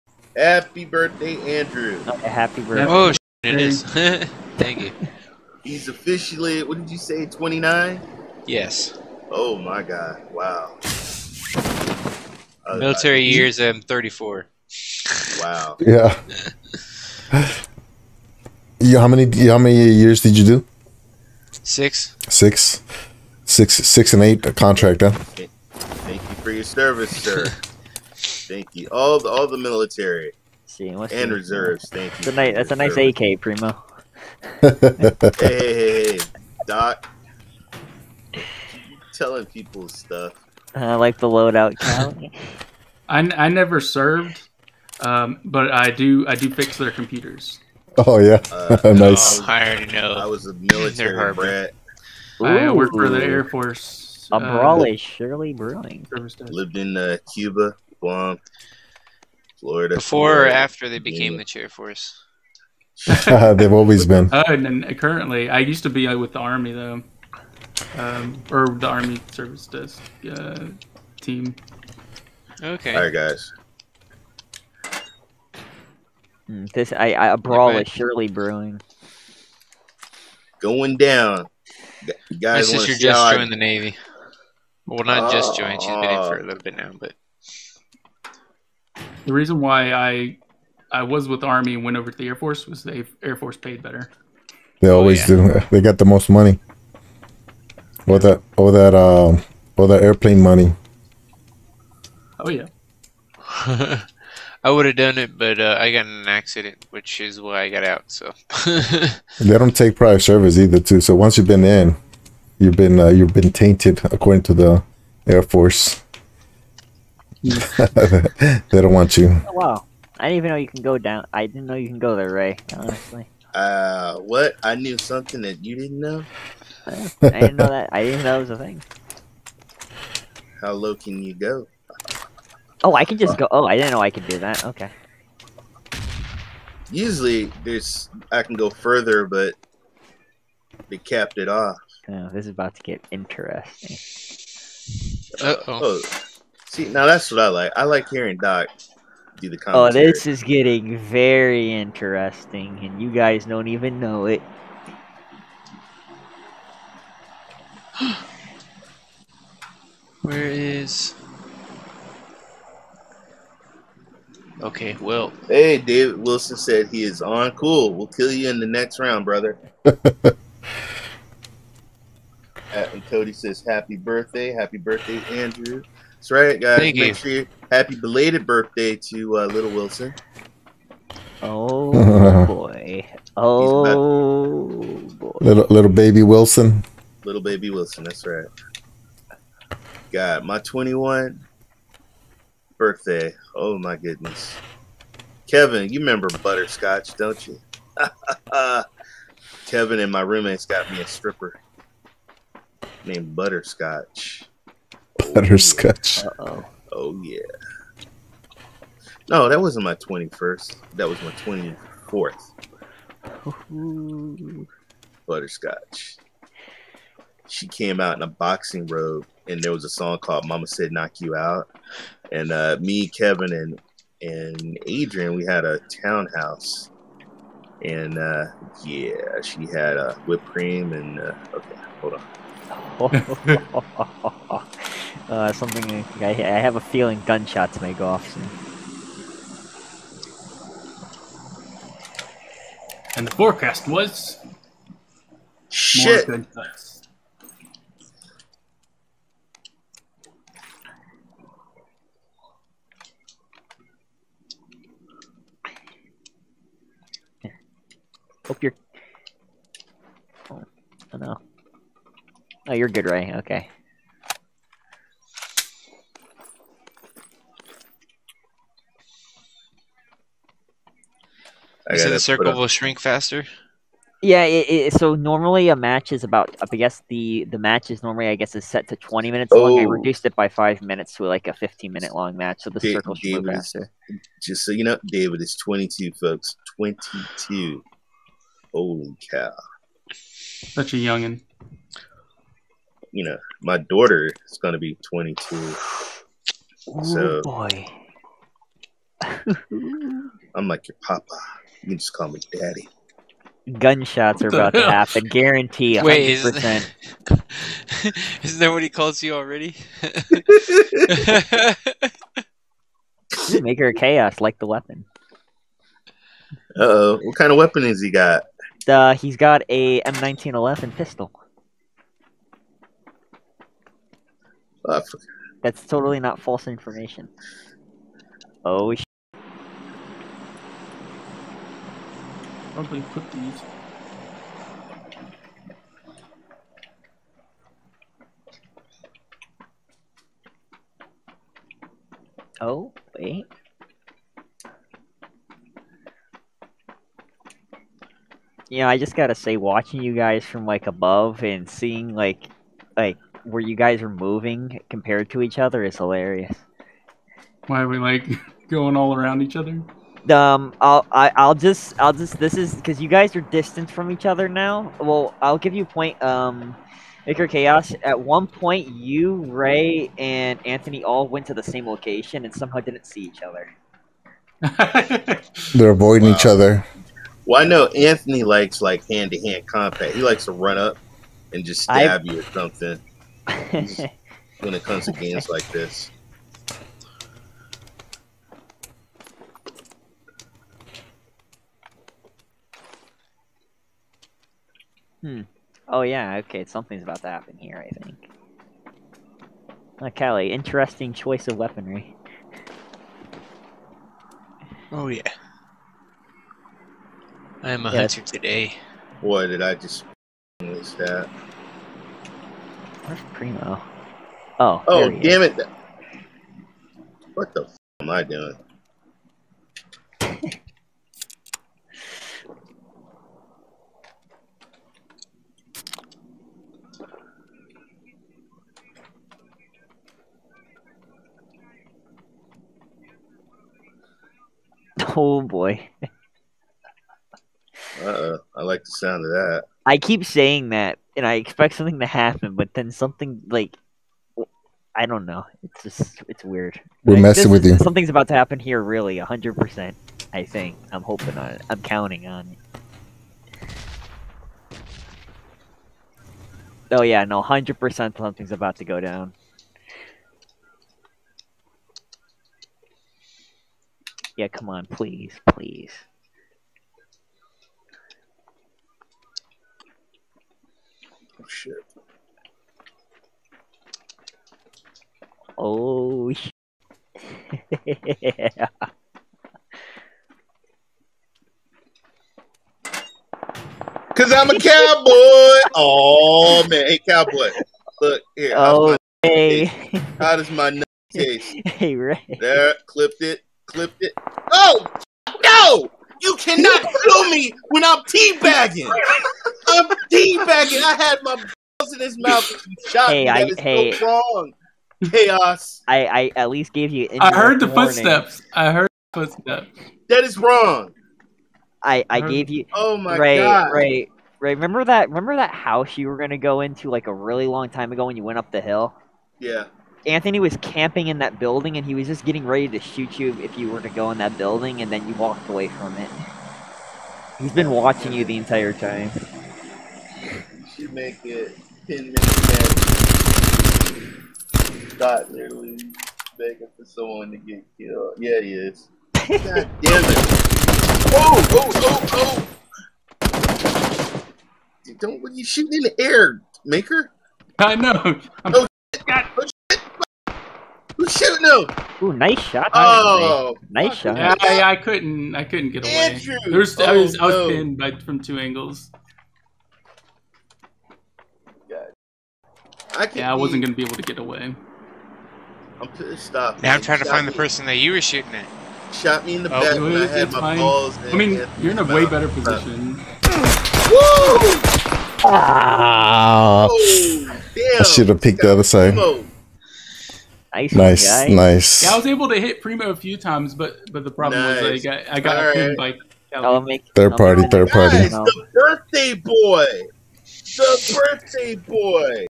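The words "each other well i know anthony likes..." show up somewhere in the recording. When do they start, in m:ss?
6:16.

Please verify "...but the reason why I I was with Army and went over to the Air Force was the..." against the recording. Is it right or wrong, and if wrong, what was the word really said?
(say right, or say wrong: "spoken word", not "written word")
right.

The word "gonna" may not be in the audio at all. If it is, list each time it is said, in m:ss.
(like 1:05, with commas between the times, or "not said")
8:36, 9:23.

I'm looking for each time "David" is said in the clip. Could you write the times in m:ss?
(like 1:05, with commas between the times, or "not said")
2:45, 4:45.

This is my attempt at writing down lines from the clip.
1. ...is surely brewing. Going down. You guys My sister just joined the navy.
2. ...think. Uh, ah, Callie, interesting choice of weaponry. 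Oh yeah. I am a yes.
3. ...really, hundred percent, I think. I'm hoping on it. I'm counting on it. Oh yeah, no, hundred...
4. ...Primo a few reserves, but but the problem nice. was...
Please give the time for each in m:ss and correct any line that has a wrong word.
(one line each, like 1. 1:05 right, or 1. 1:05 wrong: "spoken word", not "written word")
1. 1:17 right
2. 6:38 right
3. 7:28 right
4. 9:42 wrong: "times", not "reserves".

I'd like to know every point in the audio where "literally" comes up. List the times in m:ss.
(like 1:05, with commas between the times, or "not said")
8:55.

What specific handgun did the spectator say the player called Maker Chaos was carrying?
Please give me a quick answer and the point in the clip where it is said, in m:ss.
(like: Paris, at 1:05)
M1911 pistol, at 5:20.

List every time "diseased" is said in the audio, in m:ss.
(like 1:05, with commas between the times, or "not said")
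not said.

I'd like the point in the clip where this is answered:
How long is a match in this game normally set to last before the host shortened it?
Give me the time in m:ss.
4:38.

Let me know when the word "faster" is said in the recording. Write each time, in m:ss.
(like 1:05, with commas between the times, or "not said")
4:32, 4:43.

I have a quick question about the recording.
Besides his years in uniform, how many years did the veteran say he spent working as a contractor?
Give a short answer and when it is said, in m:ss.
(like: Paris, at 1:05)
8, at 0:24.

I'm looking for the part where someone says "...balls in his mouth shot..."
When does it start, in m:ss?
8:21.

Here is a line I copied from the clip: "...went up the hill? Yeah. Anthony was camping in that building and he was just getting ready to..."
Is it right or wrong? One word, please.
right.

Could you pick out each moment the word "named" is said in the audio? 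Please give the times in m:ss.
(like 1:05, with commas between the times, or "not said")
3:23.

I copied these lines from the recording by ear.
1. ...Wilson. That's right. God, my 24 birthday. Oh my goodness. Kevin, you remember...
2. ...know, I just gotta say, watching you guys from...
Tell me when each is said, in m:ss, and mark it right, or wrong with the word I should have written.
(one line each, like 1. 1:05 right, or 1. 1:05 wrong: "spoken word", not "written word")
1. 3:07 wrong: "21", not "24"
2. 5:48 right.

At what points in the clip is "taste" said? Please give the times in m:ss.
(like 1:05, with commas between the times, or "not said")
8:11.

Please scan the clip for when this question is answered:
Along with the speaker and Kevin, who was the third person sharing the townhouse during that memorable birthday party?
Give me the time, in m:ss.
3:44.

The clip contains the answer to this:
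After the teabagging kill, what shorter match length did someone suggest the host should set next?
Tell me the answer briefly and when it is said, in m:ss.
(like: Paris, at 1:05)
10 minutes, at 8:51.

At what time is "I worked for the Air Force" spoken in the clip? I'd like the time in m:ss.
0:52.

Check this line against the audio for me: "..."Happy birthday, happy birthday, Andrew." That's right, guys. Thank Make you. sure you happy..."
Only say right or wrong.
right.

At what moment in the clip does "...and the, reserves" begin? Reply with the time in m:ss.
0:31.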